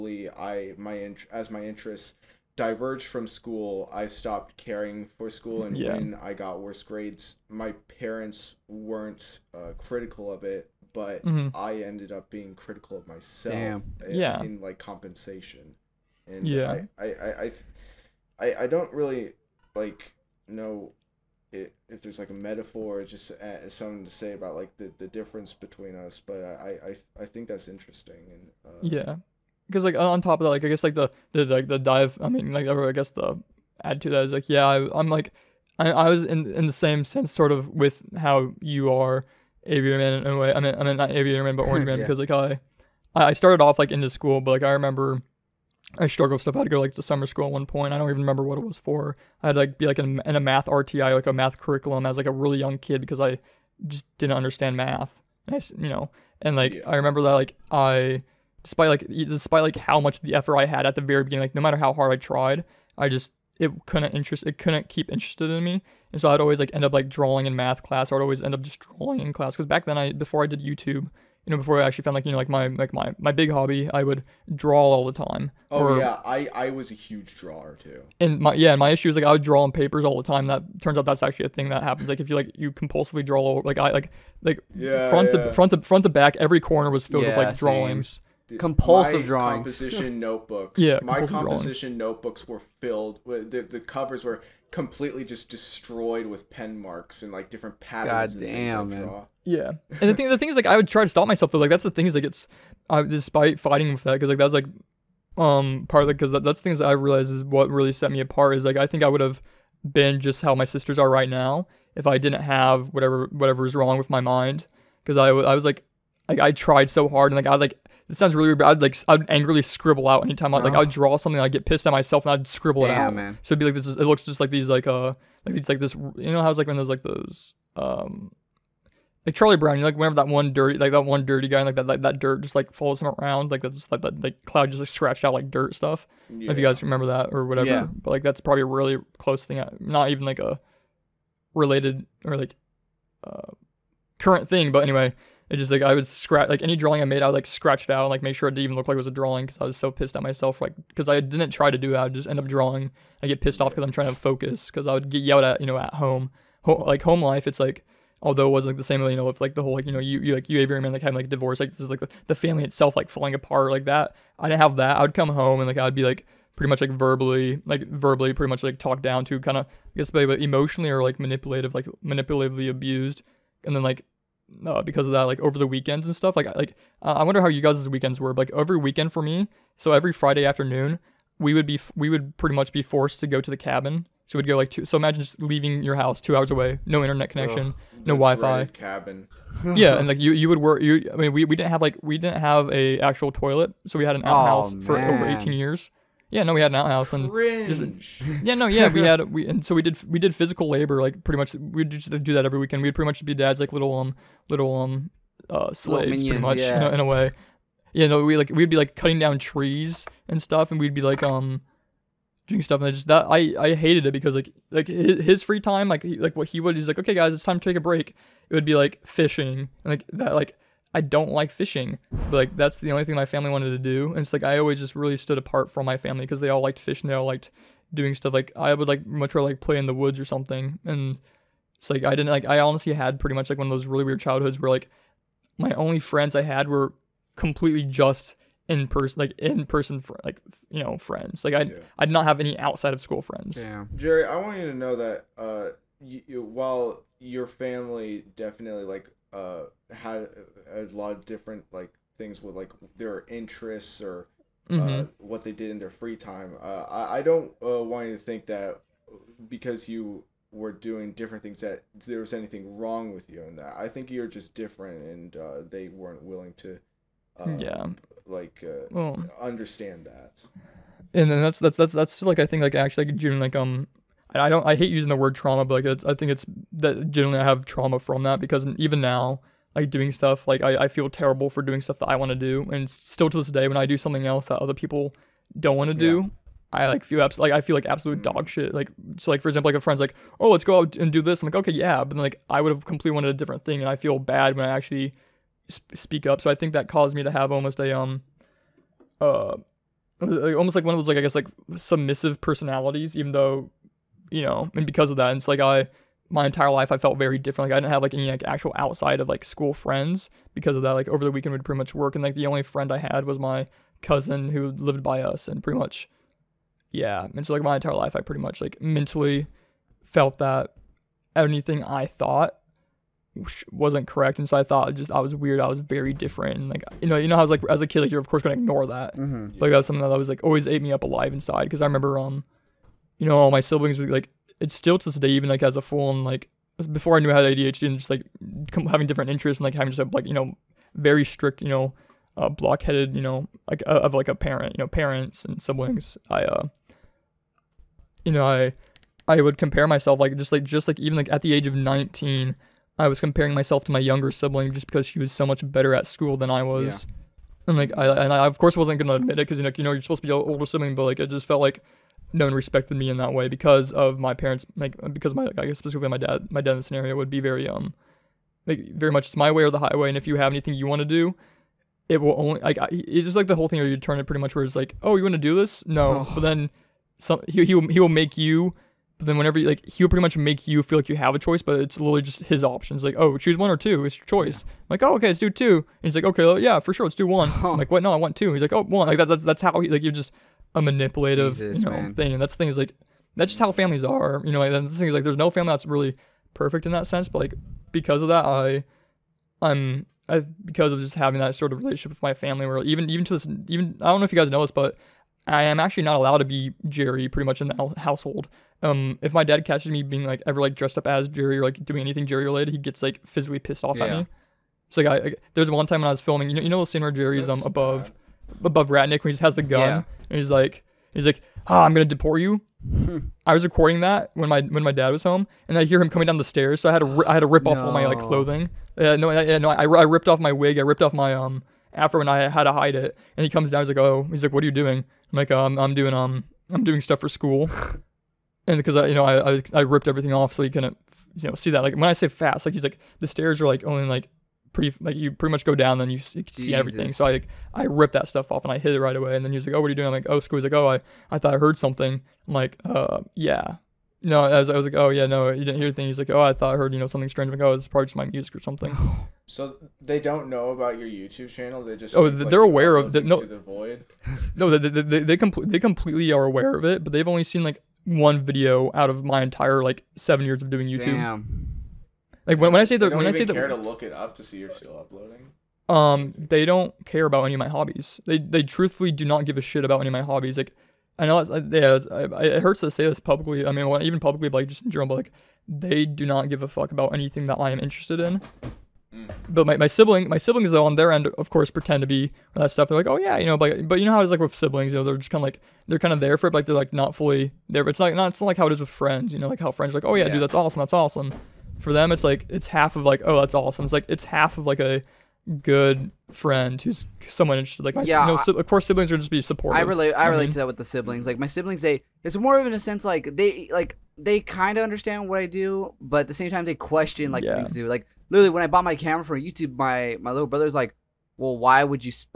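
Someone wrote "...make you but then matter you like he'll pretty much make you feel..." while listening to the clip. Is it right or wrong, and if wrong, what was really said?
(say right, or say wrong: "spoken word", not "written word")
wrong: "whenever", not "matter".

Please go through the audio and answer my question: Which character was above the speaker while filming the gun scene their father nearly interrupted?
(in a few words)
Ratnik.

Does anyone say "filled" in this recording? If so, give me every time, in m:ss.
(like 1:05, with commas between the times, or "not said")
1:27, 1:32.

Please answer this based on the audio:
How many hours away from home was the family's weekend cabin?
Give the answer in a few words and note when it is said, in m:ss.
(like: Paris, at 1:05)
2 hours, at 3:06.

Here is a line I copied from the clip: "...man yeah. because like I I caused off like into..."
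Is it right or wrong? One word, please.
wrong.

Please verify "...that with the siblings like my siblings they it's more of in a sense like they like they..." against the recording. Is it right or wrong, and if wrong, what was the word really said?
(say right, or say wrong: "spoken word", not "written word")
right.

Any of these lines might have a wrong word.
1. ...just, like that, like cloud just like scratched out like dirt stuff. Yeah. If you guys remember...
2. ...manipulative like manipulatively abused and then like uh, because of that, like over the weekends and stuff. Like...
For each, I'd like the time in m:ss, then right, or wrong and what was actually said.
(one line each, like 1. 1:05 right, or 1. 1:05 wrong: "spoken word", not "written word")
1. 2:13 right
2. 2:51 right.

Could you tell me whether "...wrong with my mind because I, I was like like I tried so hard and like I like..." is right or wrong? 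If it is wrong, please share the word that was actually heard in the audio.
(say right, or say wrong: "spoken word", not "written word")
right.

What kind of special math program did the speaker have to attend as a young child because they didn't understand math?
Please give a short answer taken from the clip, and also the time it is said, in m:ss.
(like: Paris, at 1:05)
math RTI, at 0:50.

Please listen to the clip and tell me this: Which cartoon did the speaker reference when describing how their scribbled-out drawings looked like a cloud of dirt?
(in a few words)
Charlie Brown.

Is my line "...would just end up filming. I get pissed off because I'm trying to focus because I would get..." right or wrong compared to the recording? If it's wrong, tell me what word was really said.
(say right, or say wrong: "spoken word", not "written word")
wrong: "drawing", not "filming".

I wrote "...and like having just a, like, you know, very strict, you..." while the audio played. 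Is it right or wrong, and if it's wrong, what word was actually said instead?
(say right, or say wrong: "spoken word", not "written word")
right.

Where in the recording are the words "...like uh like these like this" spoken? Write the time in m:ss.
2:04.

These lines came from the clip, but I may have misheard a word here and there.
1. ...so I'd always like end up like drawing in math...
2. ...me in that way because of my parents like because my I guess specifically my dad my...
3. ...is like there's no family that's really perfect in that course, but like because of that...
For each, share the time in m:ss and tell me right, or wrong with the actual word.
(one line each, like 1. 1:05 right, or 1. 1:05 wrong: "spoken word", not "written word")
1. 1:06 right
2. 6:02 right
3. 6:35 wrong: "sense", not "course".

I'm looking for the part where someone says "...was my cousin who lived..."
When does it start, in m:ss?
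5:13.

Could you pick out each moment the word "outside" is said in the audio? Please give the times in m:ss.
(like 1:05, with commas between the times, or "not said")
4:02, 5:08.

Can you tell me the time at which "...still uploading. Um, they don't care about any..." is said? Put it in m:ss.
7:54.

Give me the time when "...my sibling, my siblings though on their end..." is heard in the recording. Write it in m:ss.
8:09.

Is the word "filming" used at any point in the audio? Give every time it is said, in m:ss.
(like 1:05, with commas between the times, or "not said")
6:56.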